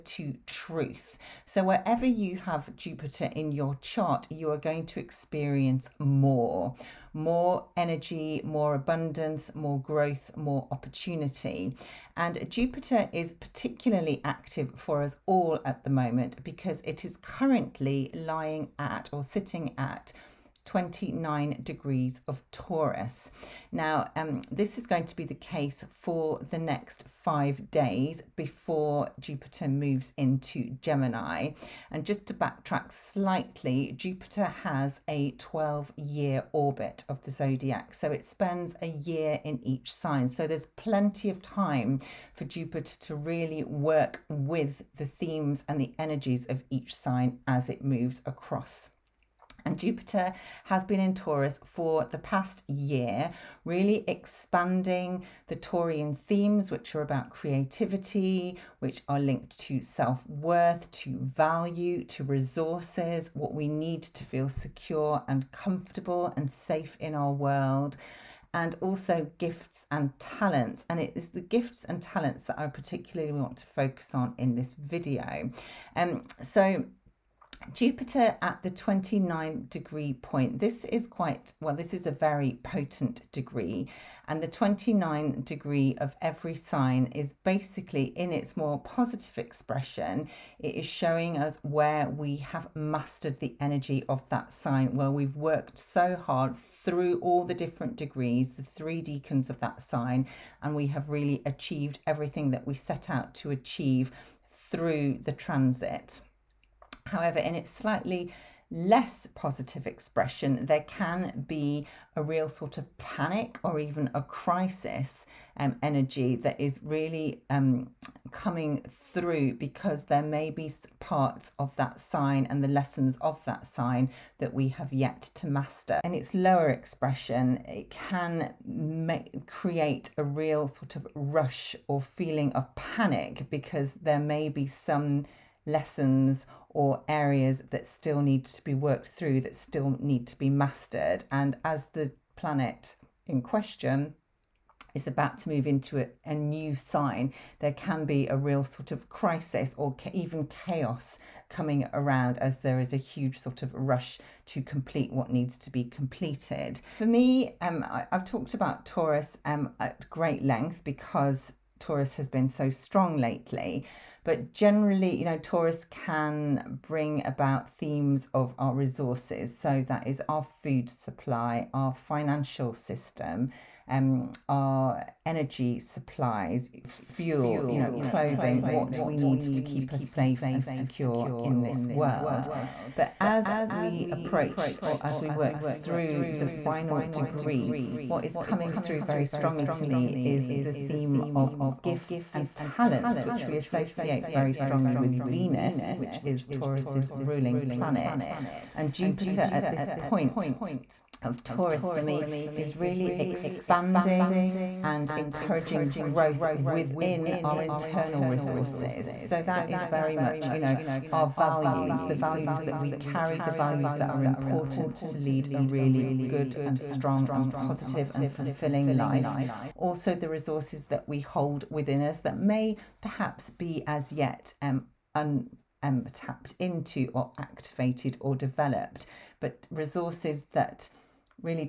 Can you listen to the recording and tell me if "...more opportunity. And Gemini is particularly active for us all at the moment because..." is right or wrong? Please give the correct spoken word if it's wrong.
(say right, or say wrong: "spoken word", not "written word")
wrong: "Jupiter", not "Gemini".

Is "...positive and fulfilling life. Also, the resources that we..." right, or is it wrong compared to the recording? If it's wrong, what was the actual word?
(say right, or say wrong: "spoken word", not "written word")
right.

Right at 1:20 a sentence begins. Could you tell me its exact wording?
This is quite, well, this is a very potent degree.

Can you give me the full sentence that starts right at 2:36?
For me, um, I, have talked about Taurus um, at great length because Taurus has been so strong lately.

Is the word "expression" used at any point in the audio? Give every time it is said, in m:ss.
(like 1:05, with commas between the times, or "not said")
1:29, 1:49, 2:06.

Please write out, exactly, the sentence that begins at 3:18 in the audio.
And Jupiter at this point of Taurus for me is really expanding and encouraging growth within our internal resources.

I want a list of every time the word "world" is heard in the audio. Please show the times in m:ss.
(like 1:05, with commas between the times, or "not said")
1:07, 3:01.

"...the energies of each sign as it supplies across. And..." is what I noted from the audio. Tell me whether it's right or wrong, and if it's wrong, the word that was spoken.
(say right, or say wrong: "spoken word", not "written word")
wrong: "moves", not "supplies".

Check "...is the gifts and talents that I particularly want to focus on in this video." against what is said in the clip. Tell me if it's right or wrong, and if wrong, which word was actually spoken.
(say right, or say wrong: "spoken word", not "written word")
right.